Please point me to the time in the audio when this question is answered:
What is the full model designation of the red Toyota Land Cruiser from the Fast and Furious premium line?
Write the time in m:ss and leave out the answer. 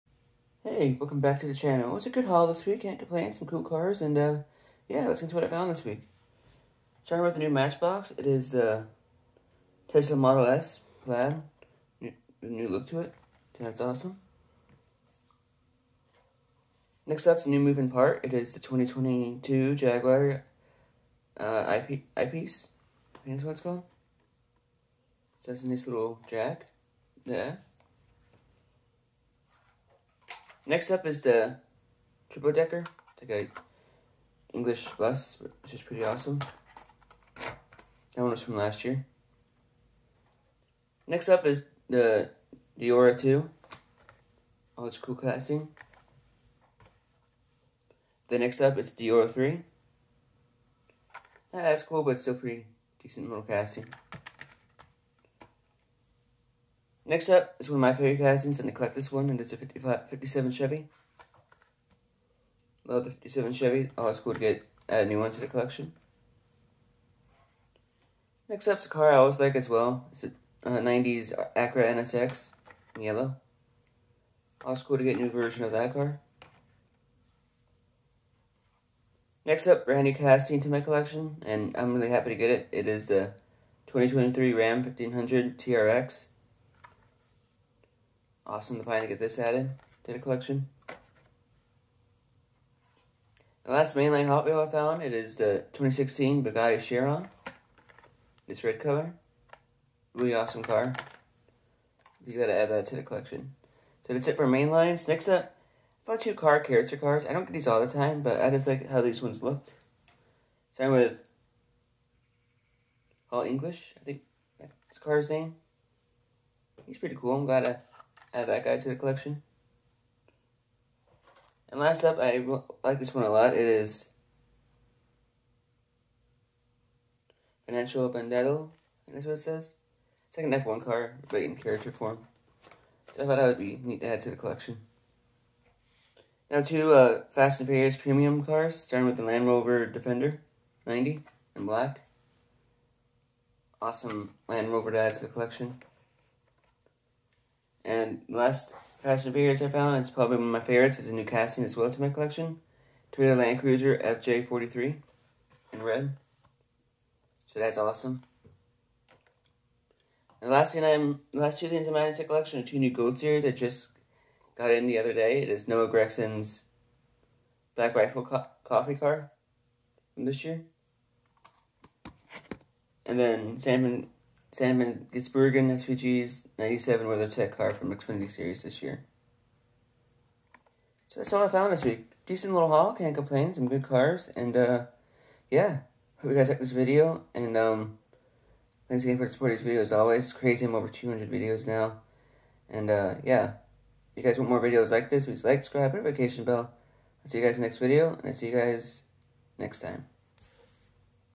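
2:34.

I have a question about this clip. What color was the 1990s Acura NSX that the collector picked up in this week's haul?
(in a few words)
Yellow.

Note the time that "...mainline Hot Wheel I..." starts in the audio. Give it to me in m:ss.
1:33.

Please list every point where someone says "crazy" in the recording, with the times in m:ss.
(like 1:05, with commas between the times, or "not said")
3:10.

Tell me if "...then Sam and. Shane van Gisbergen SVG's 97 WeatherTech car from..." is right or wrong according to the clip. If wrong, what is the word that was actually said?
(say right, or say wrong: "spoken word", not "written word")
right.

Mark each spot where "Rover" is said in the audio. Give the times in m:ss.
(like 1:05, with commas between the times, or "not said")
2:19, 2:24.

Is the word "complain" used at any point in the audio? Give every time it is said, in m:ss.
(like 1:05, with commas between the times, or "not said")
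0:02, 3:03.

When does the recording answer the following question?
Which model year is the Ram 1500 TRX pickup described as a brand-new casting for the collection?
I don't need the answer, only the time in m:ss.
1:23.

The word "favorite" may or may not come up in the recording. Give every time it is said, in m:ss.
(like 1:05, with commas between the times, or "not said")
0:57, 2:30.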